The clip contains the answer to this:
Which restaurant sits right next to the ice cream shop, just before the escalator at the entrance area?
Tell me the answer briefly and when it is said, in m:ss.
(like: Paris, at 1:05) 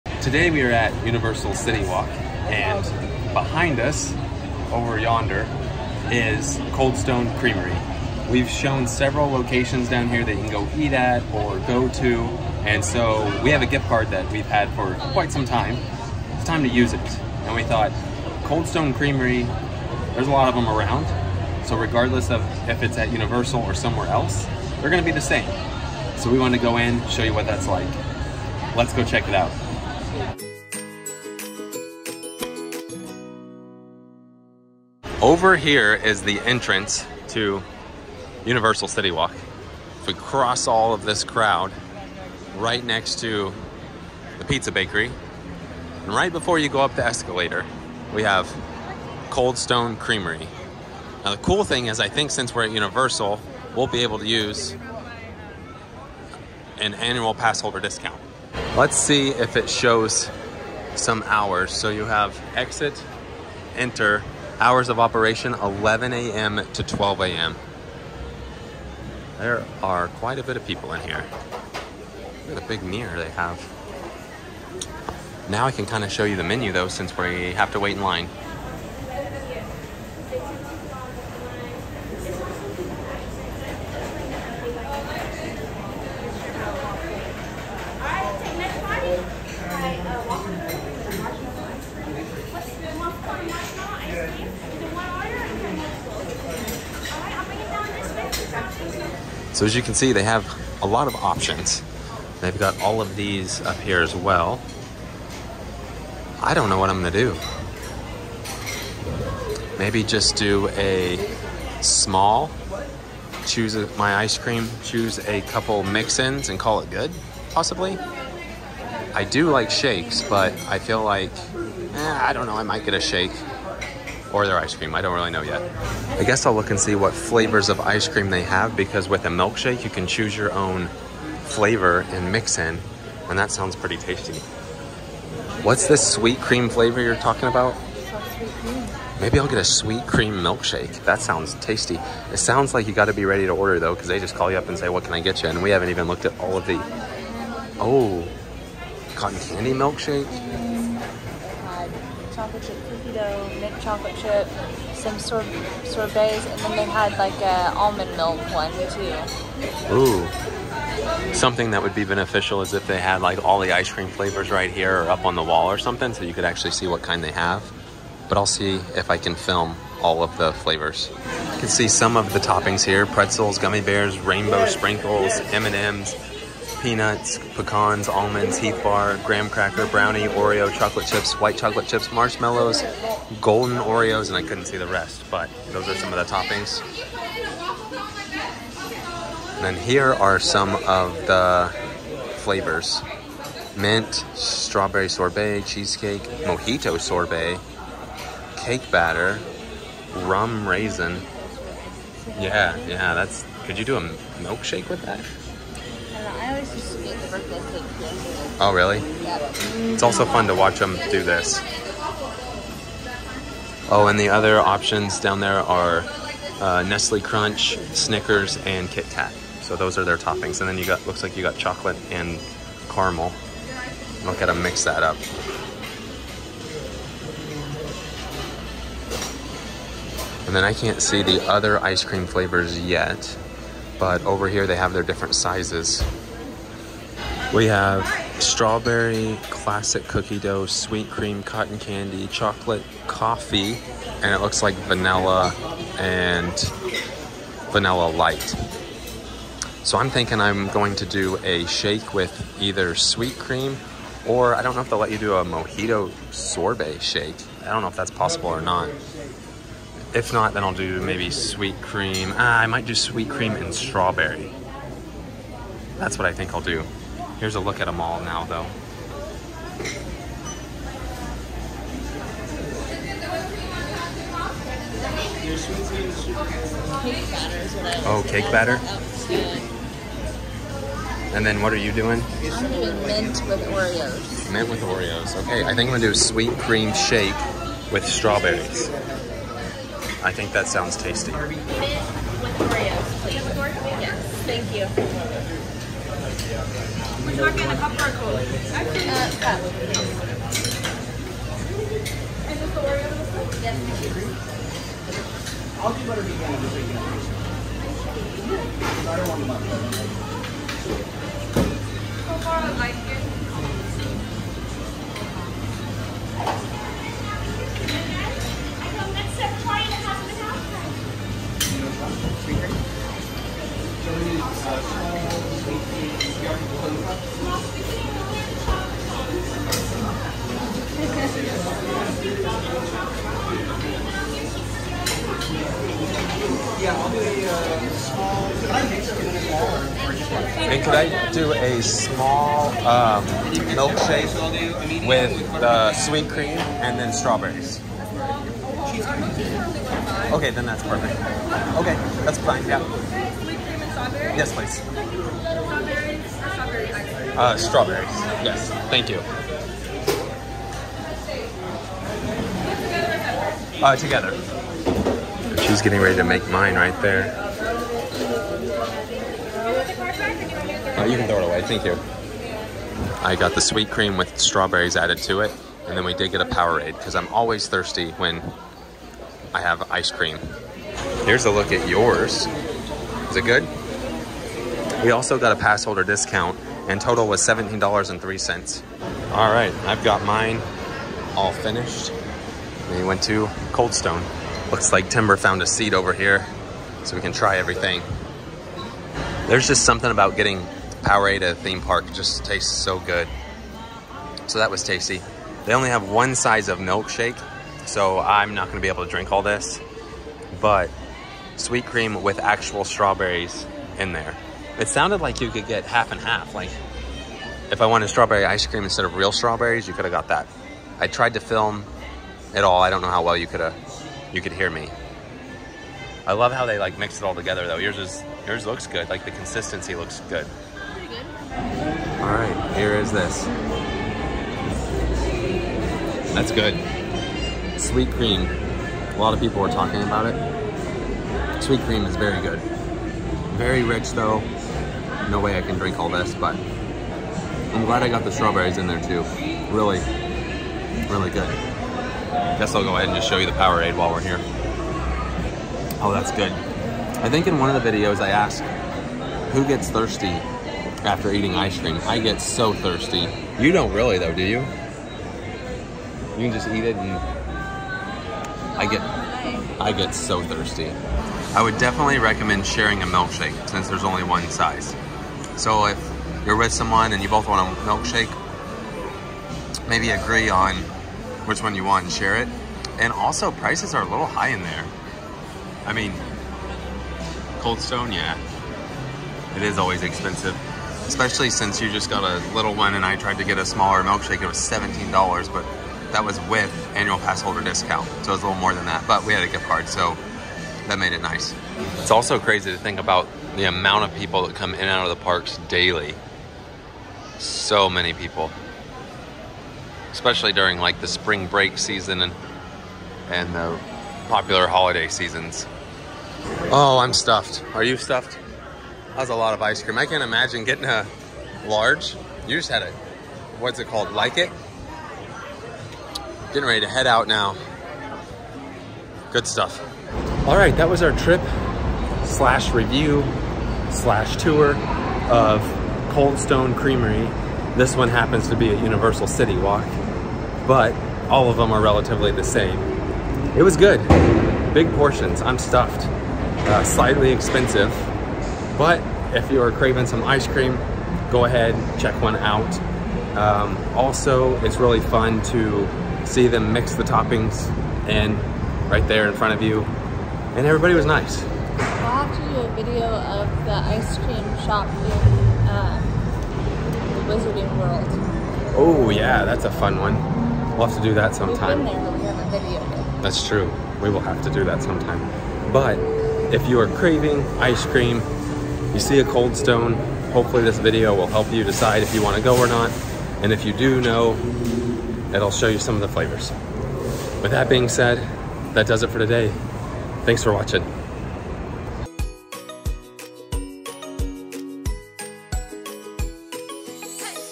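pizza bakery, at 0:44.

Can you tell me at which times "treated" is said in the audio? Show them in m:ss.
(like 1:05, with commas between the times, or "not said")
not said.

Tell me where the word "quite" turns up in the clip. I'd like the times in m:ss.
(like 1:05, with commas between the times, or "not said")
0:15, 1:10.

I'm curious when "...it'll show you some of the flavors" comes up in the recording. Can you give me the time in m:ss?
9:45.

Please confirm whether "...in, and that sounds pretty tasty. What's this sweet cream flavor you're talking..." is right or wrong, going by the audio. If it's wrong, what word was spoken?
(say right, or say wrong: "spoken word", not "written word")
right.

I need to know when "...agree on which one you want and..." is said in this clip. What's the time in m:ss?
8:00.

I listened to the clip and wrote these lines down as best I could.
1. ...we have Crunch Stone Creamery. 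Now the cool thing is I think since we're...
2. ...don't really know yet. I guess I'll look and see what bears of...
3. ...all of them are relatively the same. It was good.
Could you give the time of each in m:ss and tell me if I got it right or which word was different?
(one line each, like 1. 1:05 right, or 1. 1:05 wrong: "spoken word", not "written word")
1. 0:48 wrong: "Cold", not "Crunch"
2. 2:05 wrong: "flavors", not "bears"
3. 9:01 right.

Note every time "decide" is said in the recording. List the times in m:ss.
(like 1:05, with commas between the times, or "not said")
9:41.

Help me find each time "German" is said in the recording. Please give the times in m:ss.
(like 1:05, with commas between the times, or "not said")
not said.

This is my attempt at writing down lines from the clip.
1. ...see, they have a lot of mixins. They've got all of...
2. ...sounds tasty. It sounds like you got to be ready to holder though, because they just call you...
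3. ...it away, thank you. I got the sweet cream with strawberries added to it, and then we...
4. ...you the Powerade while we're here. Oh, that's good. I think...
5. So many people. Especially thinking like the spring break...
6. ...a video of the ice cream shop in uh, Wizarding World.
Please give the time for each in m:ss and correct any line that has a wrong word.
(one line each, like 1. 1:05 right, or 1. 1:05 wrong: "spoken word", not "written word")
1. 1:39 wrong: "options", not "mixins"
2. 2:21 wrong: "order", not "holder"
3. 6:11 right
4. 7:33 right
5. 8:27 wrong: "during", not "thinking"
6. 9:22 right.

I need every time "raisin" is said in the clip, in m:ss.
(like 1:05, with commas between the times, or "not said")
3:20.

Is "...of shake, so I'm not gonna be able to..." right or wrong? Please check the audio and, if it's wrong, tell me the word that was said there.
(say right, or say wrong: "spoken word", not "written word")
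wrong: "milkshake", not "shake".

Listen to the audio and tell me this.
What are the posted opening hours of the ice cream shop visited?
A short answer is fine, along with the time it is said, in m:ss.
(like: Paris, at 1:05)
11 a.m. to 12 a.m., at 1:05.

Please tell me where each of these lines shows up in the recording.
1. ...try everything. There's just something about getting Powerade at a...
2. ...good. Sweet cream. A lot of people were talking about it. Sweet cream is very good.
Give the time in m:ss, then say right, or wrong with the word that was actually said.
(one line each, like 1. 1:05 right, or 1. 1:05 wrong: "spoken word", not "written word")
1. 6:37 right
2. 7:16 right.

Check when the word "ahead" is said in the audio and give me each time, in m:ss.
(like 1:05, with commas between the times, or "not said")
7:32, 9:11.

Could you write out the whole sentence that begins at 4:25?
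That's what I think I'll do.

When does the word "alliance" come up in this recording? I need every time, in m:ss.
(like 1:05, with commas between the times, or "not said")
not said.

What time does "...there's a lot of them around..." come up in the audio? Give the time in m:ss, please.
0:20.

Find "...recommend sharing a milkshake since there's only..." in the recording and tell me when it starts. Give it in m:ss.
7:52.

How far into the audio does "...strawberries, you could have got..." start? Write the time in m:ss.
6:59.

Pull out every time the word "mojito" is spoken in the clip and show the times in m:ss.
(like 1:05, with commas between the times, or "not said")
3:16, 4:15.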